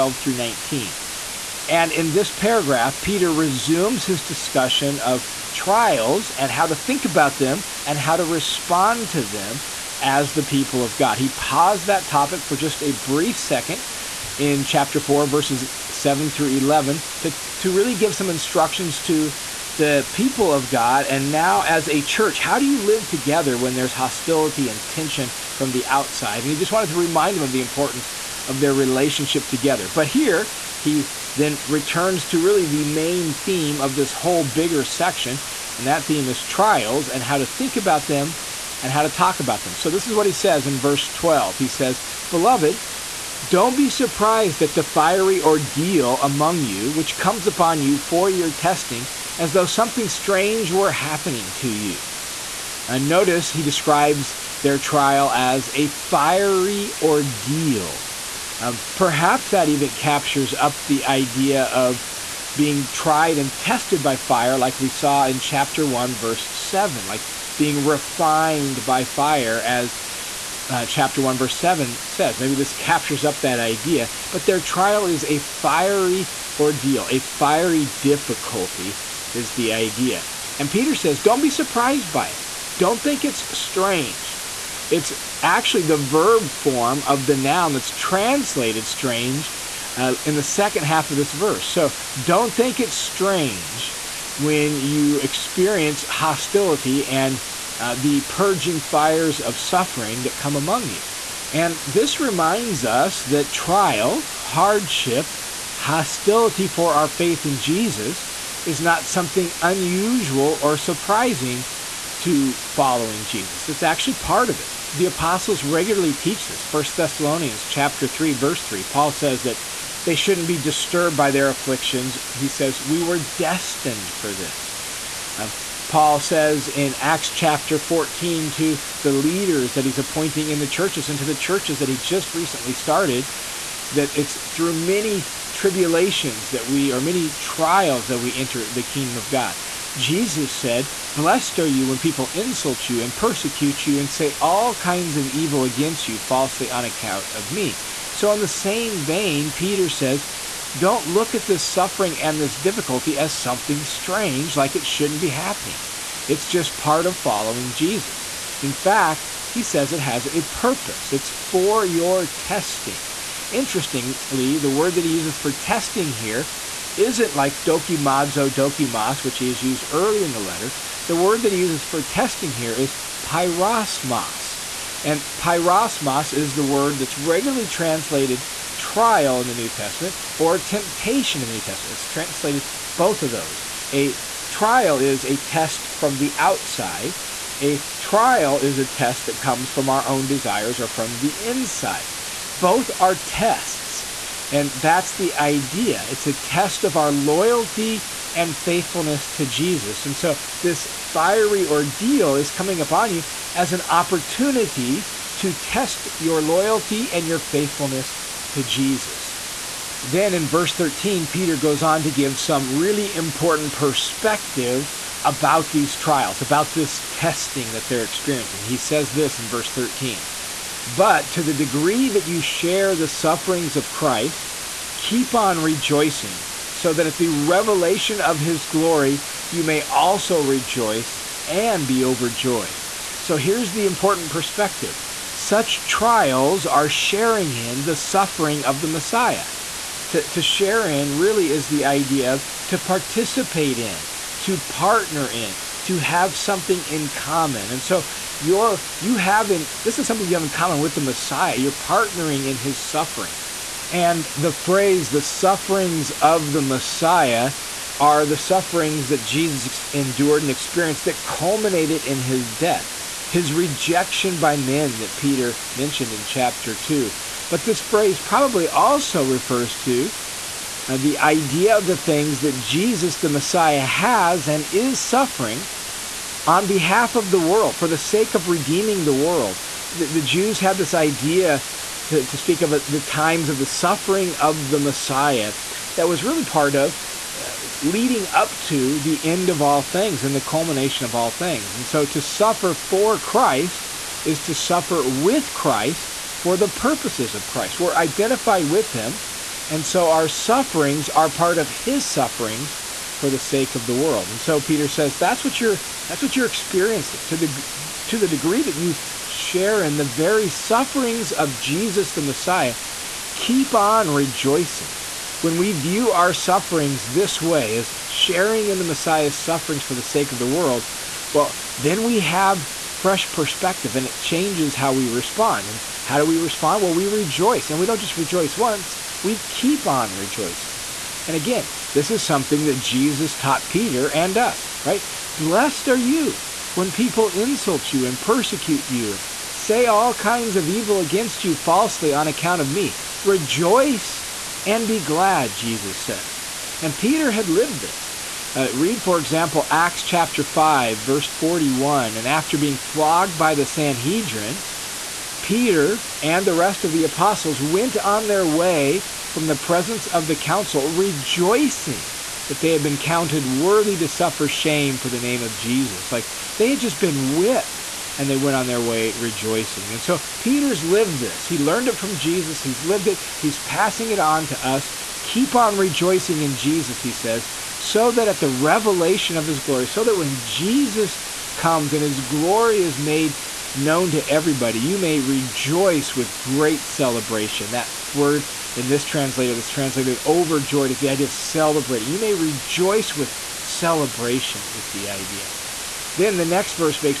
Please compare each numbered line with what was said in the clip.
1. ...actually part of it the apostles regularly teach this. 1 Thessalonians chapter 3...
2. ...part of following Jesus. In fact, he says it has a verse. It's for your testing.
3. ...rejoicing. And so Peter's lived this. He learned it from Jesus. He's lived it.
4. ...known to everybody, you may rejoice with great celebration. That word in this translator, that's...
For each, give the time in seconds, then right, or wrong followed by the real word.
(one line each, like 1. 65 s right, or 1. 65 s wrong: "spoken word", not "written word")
1. 113 s right
2. 156 s wrong: "purpose", not "verse"
3. 369 s right
4. 383 s right.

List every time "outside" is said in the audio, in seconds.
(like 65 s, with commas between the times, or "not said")
25 s, 186 s.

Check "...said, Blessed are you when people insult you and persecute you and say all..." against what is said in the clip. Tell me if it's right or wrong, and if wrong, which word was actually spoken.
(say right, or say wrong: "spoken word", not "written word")
right.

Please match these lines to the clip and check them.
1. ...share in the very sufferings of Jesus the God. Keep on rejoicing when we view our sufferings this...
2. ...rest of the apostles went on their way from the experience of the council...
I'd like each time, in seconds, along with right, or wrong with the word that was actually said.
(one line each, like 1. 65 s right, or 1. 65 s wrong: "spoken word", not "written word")
1. 309 s wrong: "Messiah", not "God"
2. 356 s wrong: "presence", not "experience".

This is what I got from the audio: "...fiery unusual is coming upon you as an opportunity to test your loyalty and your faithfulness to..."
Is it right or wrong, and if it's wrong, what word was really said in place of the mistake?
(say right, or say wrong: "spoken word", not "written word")
wrong: "ordeal", not "unusual".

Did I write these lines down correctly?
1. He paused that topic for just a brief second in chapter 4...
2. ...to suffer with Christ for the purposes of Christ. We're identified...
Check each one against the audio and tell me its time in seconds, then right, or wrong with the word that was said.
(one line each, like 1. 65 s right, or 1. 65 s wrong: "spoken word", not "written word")
1. 11 s right
2. 294 s right.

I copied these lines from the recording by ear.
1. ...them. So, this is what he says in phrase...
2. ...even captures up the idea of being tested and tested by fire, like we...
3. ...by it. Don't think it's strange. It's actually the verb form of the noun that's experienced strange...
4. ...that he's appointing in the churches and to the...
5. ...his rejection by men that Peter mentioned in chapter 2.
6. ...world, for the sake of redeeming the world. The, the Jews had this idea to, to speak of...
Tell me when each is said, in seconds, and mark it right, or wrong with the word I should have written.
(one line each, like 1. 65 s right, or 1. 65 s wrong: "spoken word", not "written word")
1. 39 s wrong: "verse", not "phrase"
2. 59 s wrong: "tried", not "tested"
3. 82 s wrong: "translated", not "experienced"
4. 129 s right
5. 263 s right
6. 277 s right.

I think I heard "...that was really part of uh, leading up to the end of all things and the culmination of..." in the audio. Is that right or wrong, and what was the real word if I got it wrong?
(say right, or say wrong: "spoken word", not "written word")
right.